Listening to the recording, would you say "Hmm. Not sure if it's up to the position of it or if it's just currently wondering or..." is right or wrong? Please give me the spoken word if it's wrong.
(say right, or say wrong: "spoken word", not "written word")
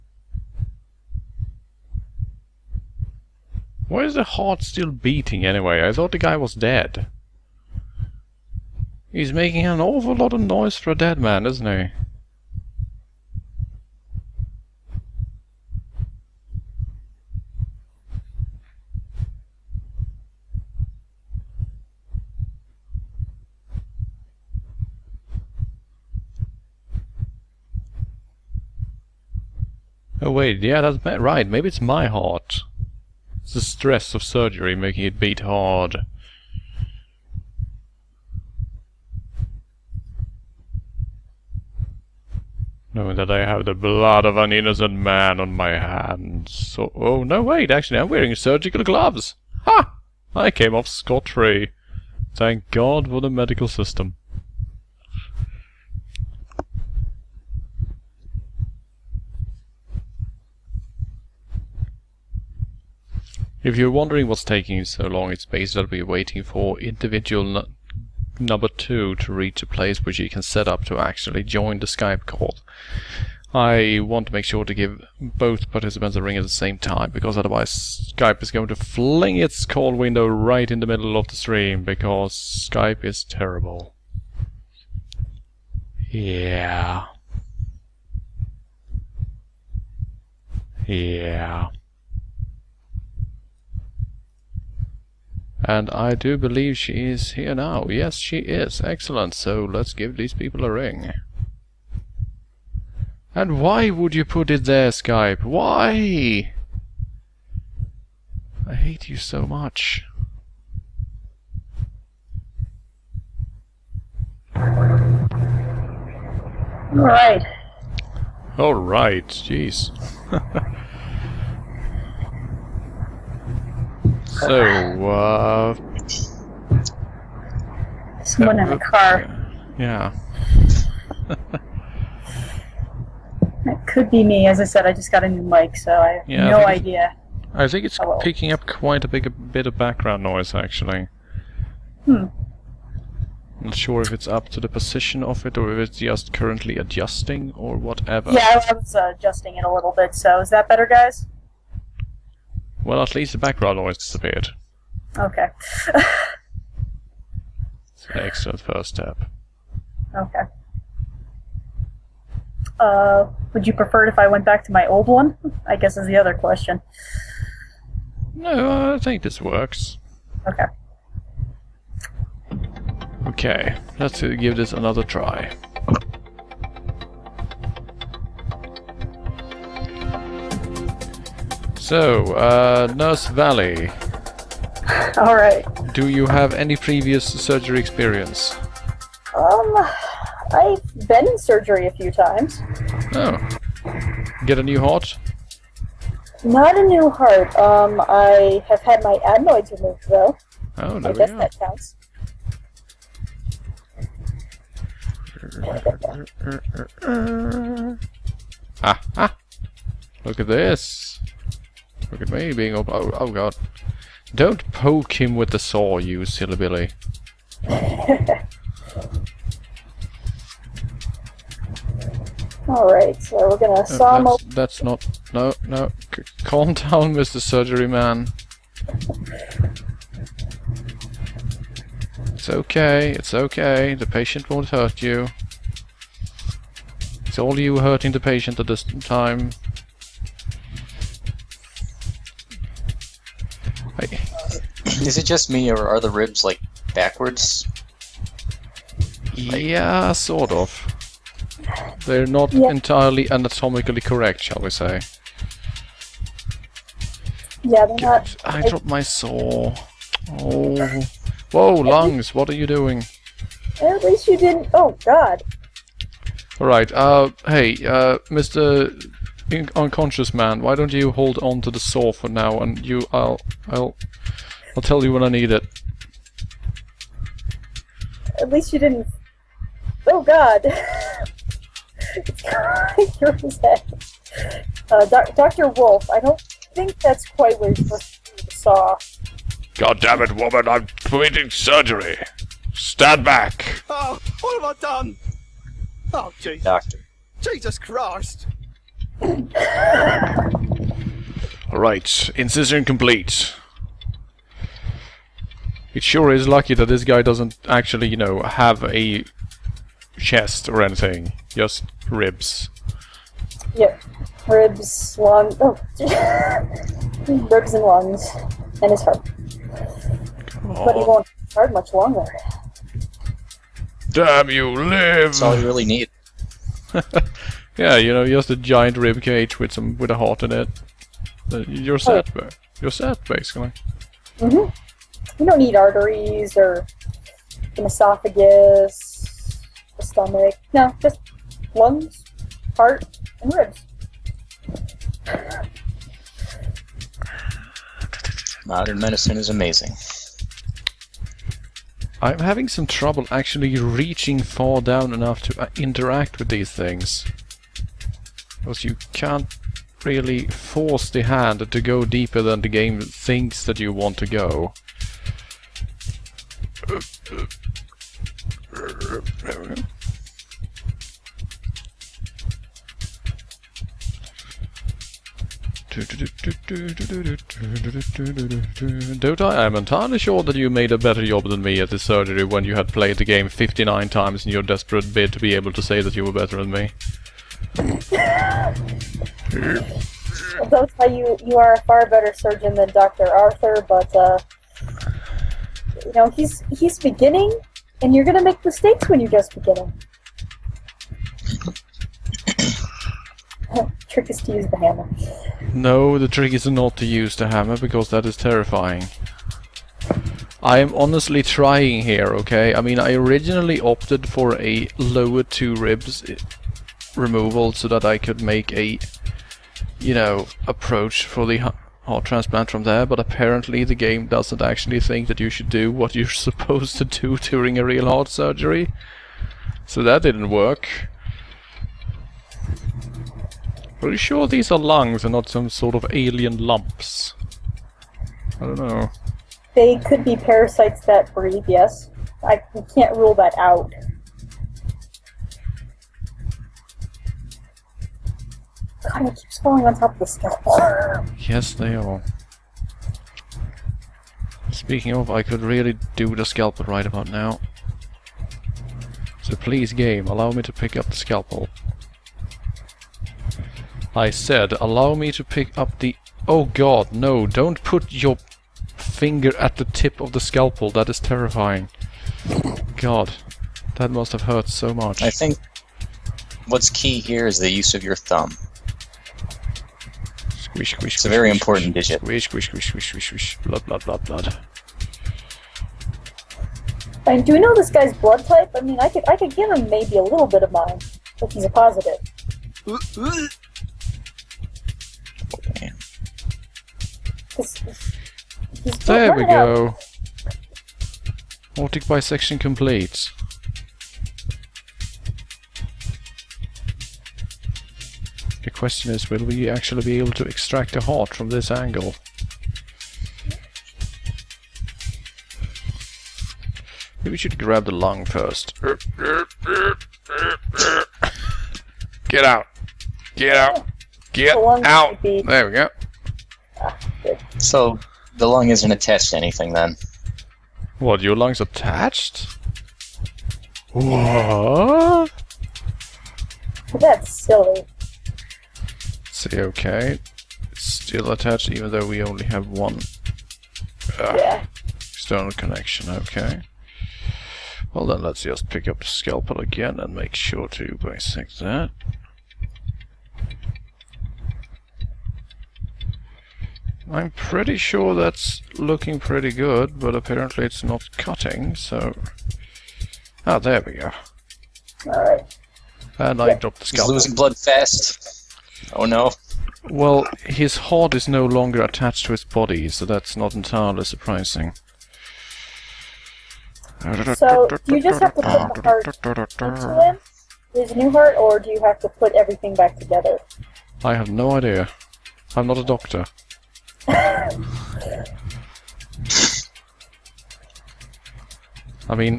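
wrong: "adjusting", not "wondering".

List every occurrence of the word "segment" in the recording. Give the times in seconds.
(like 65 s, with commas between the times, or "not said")
not said.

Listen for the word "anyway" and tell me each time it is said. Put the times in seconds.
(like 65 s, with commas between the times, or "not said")
5 s.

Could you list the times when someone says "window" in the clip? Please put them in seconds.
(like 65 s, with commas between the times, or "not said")
79 s.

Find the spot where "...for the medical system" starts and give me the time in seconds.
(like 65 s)
53 s.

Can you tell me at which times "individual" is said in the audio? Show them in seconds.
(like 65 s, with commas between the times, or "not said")
66 s.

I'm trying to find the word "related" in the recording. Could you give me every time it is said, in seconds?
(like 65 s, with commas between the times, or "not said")
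not said.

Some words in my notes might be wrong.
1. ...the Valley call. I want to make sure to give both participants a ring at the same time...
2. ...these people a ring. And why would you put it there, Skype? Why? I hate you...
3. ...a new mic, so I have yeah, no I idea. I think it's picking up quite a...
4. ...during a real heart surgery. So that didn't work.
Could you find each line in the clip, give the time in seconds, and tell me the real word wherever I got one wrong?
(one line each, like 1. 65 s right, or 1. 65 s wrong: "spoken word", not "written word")
1. 71 s wrong: "Skype", not "Valley"
2. 100 s right
3. 135 s right
4. 427 s right.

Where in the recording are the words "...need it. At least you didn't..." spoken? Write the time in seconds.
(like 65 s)
275 s.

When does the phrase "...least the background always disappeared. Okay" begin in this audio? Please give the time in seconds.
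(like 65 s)
153 s.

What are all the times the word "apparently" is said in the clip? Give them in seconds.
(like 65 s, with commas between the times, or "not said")
423 s, 560 s.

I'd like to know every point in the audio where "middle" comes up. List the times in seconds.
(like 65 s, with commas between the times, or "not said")
80 s.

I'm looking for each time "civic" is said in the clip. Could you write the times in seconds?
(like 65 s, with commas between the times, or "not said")
not said.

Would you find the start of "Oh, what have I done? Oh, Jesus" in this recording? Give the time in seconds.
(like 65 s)
293 s.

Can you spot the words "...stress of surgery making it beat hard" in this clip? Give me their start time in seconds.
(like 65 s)
33 s.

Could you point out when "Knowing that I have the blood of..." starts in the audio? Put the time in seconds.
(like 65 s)
42 s.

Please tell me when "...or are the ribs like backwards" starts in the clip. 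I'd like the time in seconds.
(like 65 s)
245 s.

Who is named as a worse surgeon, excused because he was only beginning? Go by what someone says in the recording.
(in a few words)
Dr. Arthur.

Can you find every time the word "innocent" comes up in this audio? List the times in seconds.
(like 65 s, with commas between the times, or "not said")
44 s.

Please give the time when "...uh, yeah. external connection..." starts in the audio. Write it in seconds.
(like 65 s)
544 s.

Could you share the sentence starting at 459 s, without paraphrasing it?
So please, game, allow me to pick up the scalpel.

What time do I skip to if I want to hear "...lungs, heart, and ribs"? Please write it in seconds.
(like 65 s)
341 s.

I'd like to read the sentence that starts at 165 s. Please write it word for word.
I guess is the other question.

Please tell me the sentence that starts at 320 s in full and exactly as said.
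But he won't hurt much longer.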